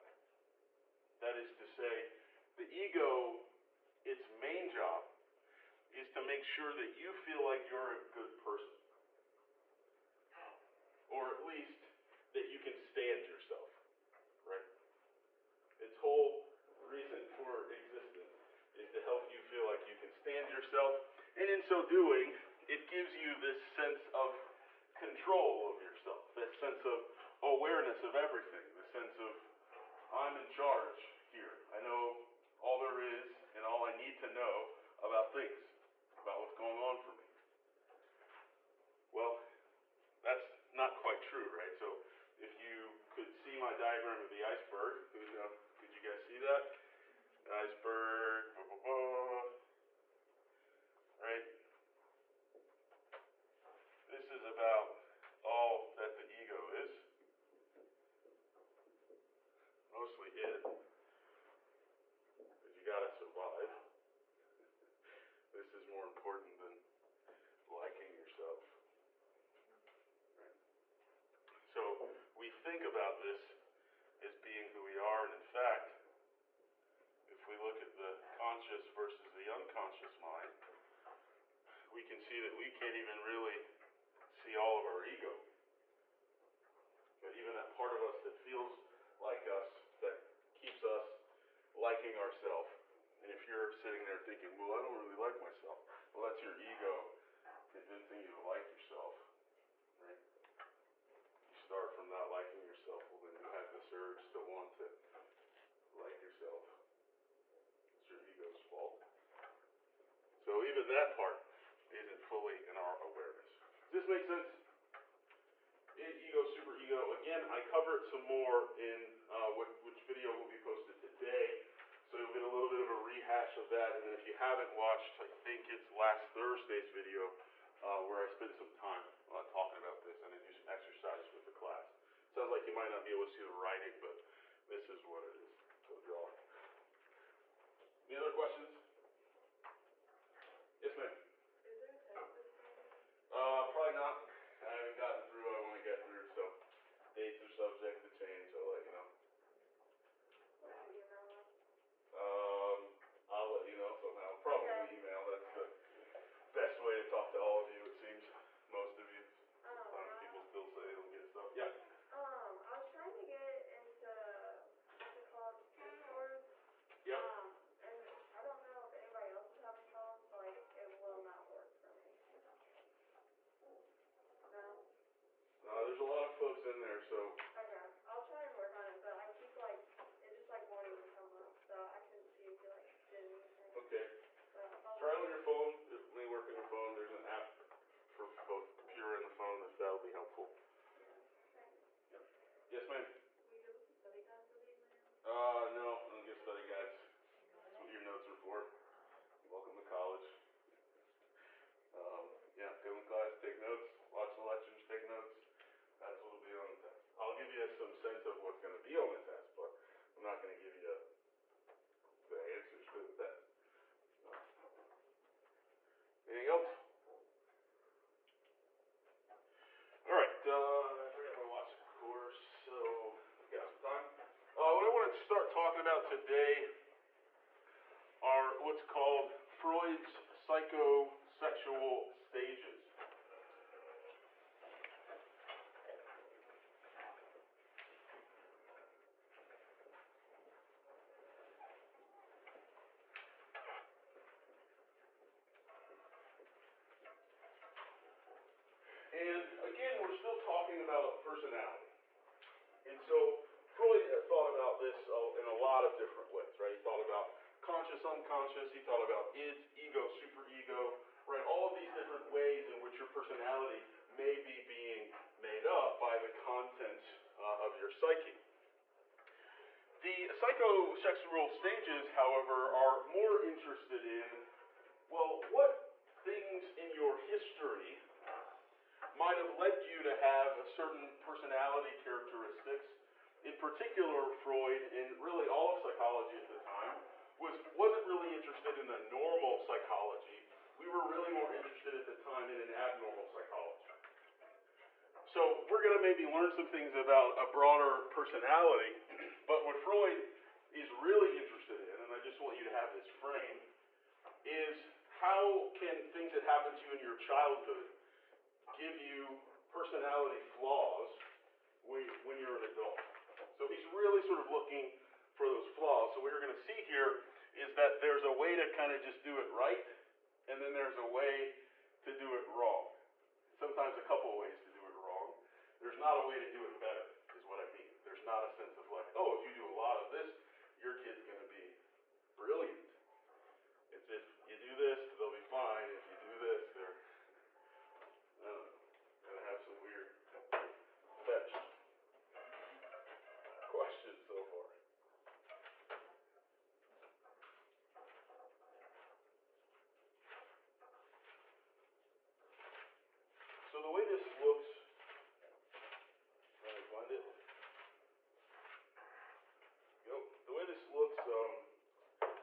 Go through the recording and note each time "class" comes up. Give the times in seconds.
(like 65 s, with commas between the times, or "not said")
131 s, 203 s.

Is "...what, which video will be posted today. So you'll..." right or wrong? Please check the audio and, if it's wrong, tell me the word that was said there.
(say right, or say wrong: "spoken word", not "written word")
right.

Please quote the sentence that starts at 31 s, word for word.
I know all there is and all I need to know about things, about what's going on for me.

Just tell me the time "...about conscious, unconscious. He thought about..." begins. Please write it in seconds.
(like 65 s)
257 s.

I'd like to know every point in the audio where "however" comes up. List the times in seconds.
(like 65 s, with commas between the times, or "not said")
272 s.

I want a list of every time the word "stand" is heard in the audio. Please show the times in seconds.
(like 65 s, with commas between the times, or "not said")
12 s, 20 s.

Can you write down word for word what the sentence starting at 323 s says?
Sometimes a couple of ways to do it wrong.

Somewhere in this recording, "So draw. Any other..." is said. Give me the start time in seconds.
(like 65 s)
135 s.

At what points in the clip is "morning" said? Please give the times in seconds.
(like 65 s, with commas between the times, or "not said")
142 s.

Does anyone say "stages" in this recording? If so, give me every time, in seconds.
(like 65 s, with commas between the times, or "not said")
232 s, 271 s.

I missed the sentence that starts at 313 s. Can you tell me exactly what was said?
So he's really sort of looking for those flaws.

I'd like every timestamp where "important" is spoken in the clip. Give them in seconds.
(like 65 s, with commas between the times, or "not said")
66 s.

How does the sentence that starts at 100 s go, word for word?
You start from not liking yourself, well, then you have this urge to want to like yourself your ego's fault.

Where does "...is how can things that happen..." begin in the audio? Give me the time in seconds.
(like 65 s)
304 s.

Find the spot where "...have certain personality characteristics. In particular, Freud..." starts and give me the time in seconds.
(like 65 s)
280 s.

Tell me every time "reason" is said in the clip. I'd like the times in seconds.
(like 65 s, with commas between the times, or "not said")
16 s.